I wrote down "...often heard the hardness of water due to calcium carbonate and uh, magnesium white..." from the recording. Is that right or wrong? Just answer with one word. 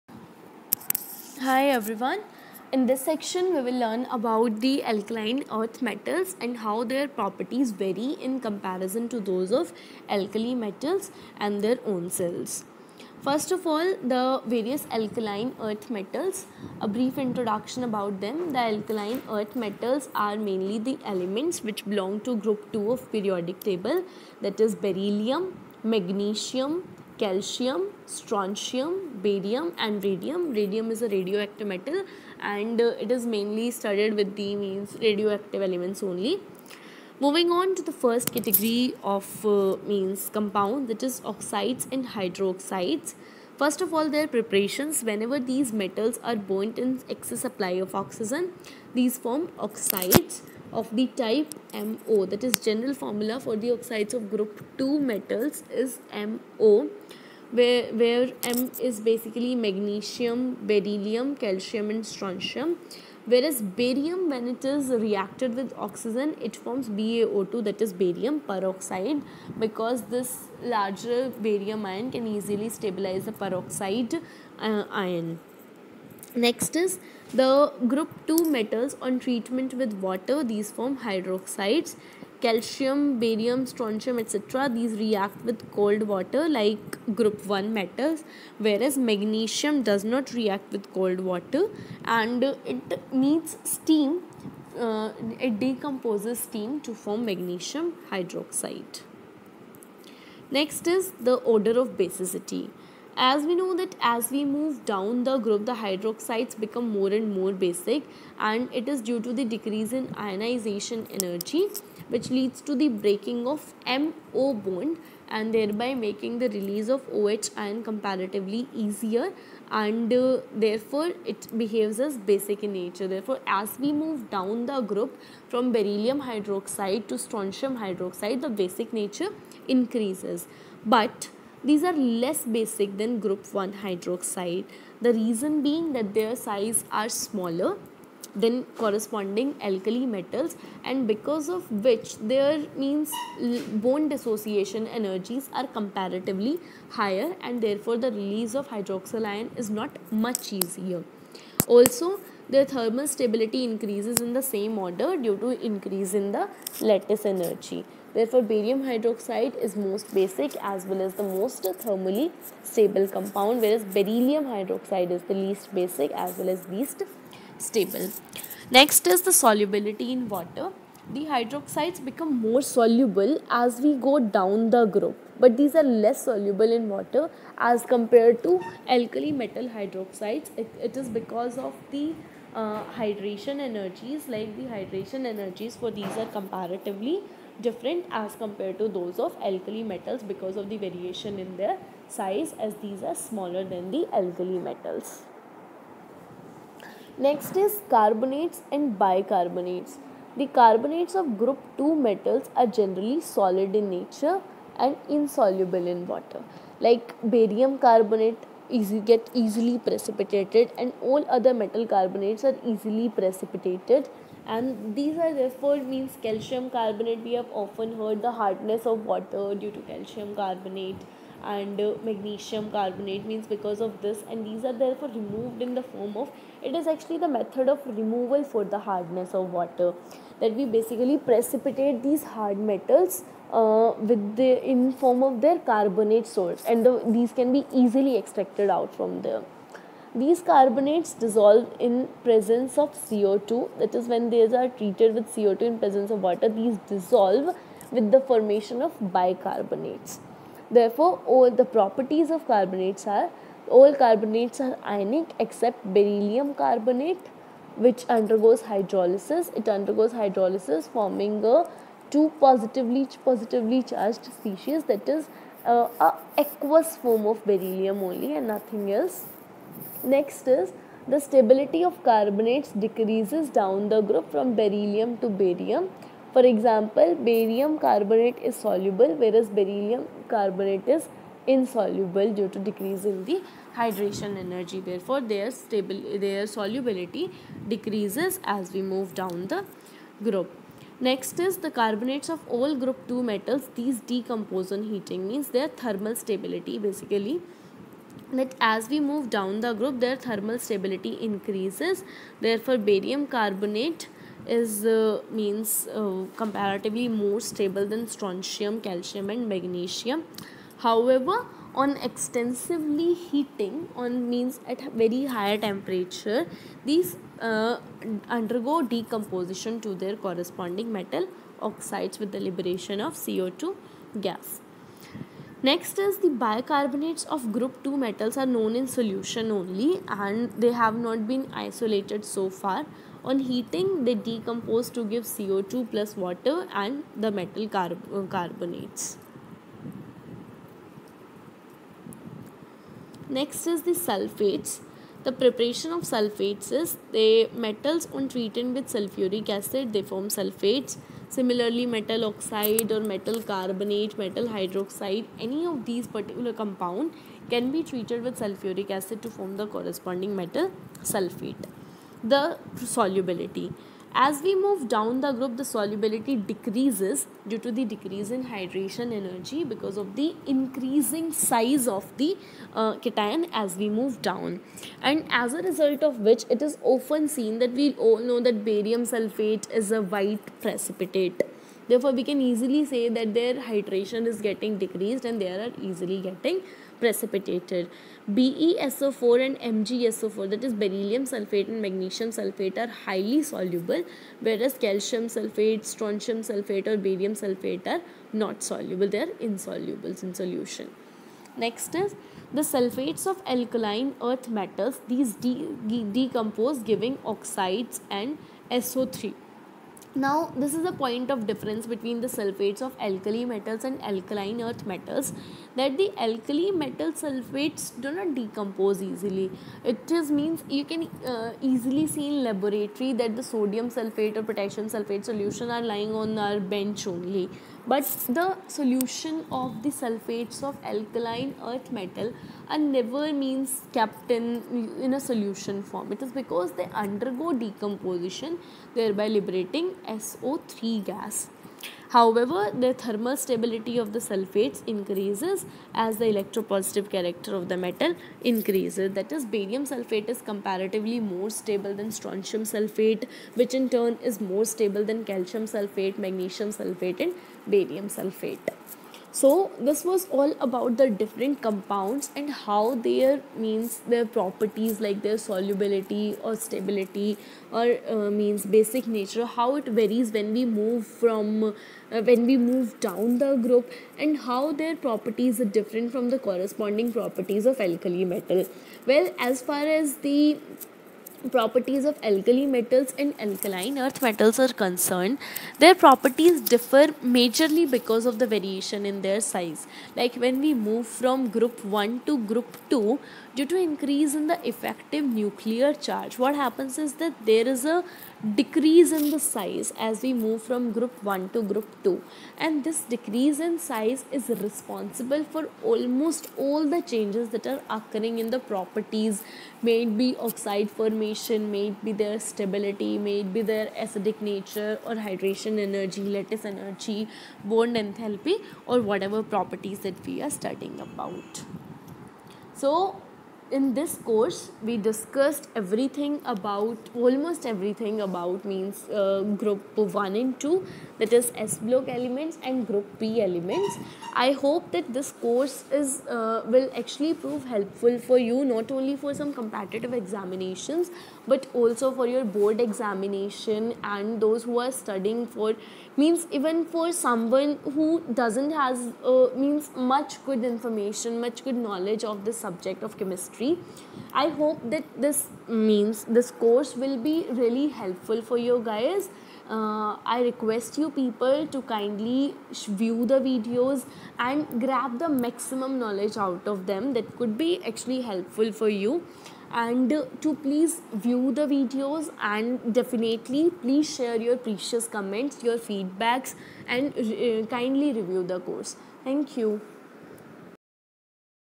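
wrong.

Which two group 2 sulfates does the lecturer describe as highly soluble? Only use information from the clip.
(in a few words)
BeSO4 and MgSO4.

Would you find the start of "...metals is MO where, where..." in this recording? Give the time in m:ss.
0:54.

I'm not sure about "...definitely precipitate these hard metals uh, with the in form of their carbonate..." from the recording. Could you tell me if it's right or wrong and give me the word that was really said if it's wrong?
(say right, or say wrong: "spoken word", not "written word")
wrong: "basically", not "definitely".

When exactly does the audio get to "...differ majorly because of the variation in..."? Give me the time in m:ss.
8:06.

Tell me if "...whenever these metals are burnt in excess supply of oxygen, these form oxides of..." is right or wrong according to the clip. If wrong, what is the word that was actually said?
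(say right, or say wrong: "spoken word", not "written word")
right.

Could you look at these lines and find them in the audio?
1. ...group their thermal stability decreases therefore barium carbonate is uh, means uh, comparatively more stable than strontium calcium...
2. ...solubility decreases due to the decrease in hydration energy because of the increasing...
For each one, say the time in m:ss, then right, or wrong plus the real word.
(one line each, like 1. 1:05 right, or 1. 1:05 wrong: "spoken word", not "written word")
1. 4:59 wrong: "increases", not "decreases"
2. 6:05 right.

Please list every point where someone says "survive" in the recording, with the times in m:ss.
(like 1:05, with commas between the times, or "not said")
not said.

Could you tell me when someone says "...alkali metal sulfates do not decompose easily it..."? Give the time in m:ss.
6:56.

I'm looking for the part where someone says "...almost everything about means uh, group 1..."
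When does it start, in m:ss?
8:47.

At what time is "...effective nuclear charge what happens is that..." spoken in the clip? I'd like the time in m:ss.
8:14.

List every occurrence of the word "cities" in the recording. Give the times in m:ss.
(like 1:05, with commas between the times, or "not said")
not said.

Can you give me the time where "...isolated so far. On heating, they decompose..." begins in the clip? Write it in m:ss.
5:31.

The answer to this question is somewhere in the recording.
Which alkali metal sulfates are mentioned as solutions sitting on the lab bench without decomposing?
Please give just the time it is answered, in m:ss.
7:03.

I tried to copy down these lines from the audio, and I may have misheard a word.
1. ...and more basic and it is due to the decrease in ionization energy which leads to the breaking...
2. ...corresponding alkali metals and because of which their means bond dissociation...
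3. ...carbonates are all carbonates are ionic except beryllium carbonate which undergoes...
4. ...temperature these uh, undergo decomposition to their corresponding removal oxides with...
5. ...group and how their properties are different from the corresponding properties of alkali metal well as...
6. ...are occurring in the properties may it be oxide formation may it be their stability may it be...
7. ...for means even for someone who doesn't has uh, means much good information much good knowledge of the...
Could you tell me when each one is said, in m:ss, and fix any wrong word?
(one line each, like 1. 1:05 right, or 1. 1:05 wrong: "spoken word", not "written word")
1. 1:47 right
2. 2:18 right
3. 4:12 right
4. 5:15 wrong: "metal", not "removal"
5. 7:53 right
6. 8:27 right
7. 9:05 right.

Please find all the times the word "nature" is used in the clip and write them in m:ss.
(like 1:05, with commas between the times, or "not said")
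2:02, 2:08, 3:23, 7:49, 8:34.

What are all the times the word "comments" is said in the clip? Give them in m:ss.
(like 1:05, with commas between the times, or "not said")
9:35.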